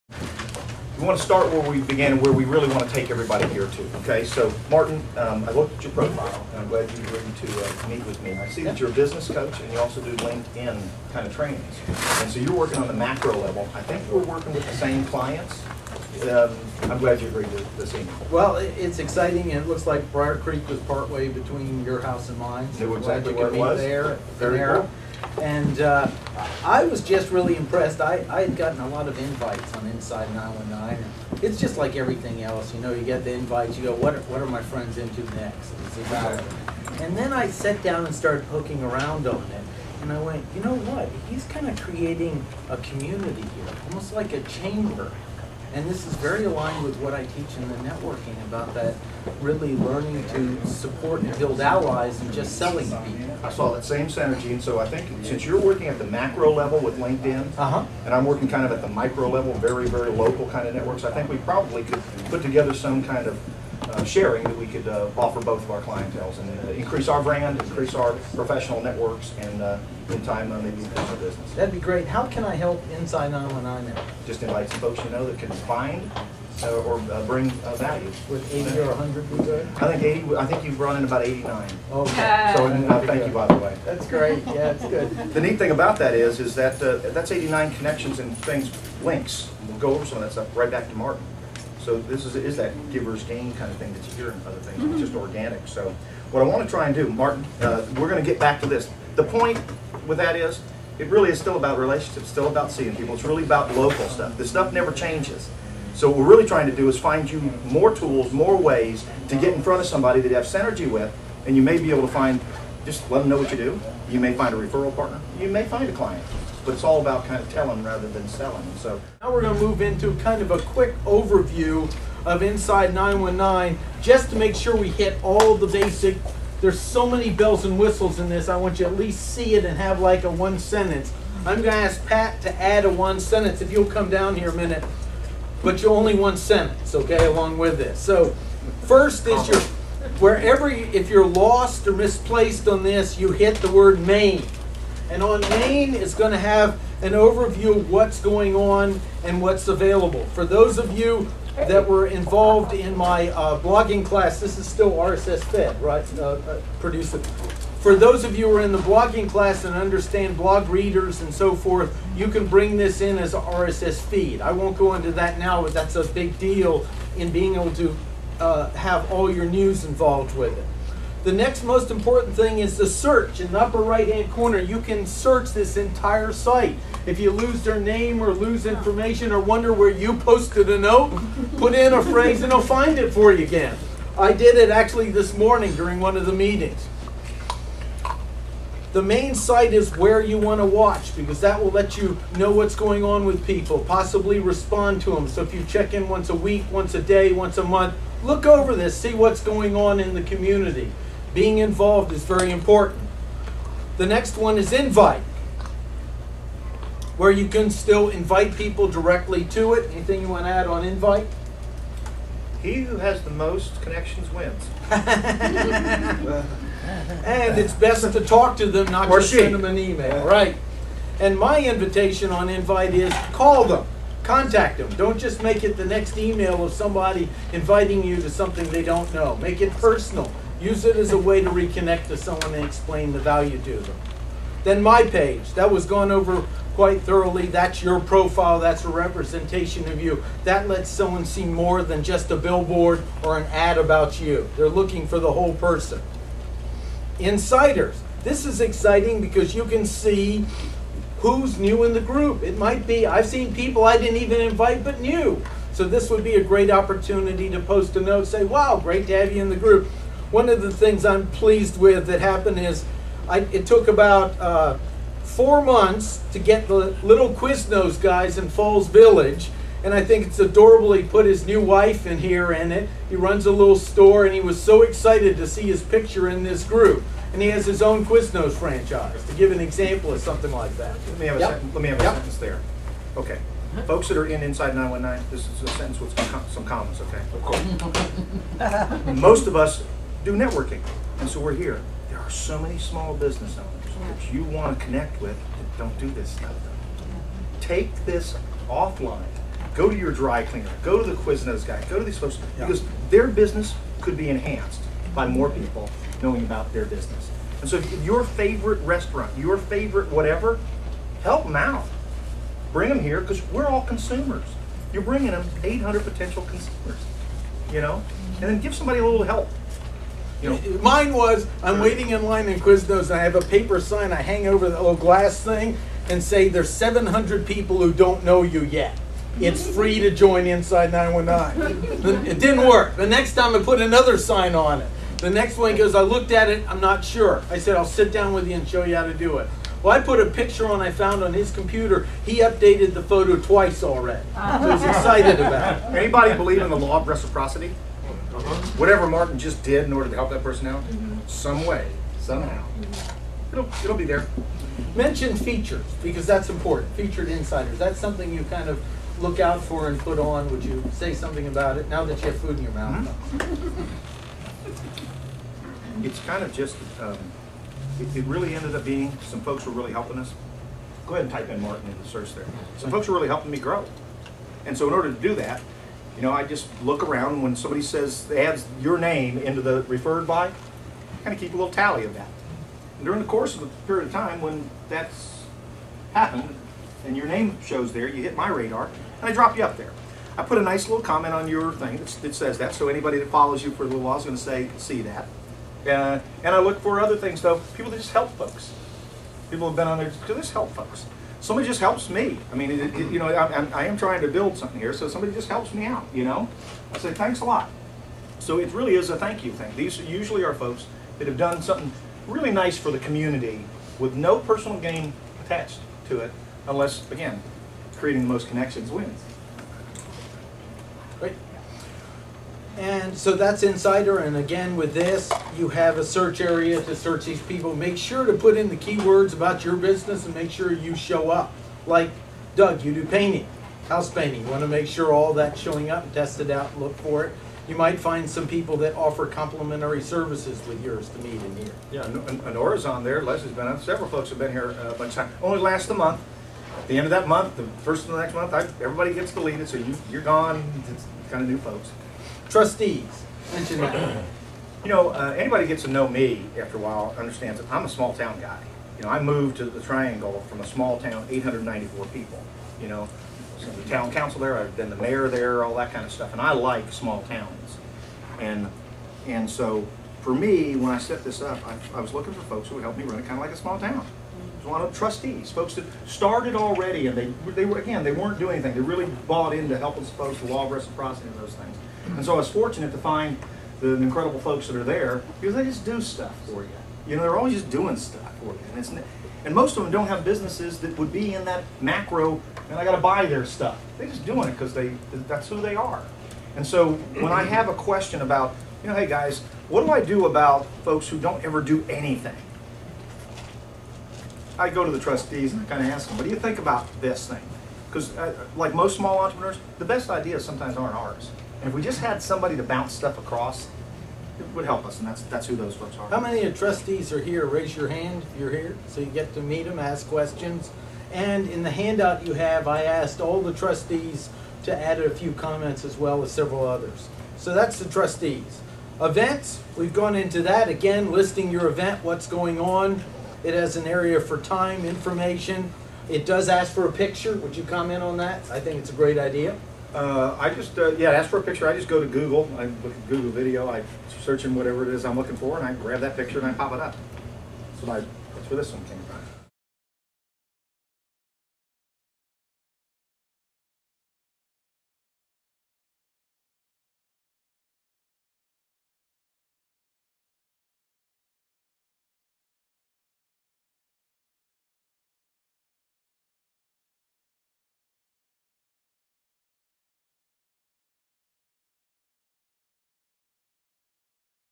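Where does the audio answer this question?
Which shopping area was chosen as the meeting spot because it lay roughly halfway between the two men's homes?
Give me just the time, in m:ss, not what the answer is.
0:20.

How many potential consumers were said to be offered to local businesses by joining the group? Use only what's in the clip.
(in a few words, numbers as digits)
800.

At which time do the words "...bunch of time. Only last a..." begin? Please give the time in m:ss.
7:24.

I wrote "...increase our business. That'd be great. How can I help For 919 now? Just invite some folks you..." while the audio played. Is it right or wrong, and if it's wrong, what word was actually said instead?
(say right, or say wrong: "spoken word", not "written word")
wrong: "Inside", not "For".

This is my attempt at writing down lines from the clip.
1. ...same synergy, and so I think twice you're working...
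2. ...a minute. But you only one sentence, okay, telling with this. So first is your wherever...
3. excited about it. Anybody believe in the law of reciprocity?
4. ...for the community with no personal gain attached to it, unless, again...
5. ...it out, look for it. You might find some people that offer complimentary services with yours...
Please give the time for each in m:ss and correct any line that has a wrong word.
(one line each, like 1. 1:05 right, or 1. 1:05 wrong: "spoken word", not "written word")
1. 0:53 wrong: "since", not "twice"
2. 2:14 wrong: "along", not "telling"
3. 5:44 right
4. 6:52 right
5. 7:16 right.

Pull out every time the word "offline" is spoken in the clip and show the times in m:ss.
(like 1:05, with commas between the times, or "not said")
4:58.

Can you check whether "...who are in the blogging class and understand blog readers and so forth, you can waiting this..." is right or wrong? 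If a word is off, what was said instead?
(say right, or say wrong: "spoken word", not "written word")
wrong: "bring", not "waiting".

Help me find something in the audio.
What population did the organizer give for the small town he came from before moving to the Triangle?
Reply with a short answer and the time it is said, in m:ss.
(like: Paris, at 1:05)
894, at 7:41.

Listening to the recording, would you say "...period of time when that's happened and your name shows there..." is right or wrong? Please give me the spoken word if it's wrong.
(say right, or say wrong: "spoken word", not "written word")
right.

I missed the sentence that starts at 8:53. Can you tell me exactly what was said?
It has an area for time, information.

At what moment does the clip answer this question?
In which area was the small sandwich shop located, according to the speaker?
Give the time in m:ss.
4:28.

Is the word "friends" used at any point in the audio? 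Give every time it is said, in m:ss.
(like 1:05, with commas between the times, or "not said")
0:34.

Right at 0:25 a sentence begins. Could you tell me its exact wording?
And uh, I was just really impressed.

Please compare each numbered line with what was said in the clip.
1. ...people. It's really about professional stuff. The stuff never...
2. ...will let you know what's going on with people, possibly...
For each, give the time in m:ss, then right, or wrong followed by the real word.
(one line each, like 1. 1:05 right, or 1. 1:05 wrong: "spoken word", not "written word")
1. 1:42 wrong: "local", not "professional"
2. 3:11 right.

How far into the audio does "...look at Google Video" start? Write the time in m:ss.
9:02.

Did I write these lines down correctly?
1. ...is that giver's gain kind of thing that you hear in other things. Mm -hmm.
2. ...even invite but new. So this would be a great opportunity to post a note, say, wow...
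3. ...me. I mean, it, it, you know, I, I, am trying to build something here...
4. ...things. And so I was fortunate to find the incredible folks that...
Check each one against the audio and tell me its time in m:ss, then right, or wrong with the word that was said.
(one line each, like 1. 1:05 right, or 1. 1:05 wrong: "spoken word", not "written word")
1. 1:32 right
2. 4:14 right
3. 6:42 right
4. 8:01 right.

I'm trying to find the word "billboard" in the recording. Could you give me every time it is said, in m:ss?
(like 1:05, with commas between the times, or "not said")
4:02.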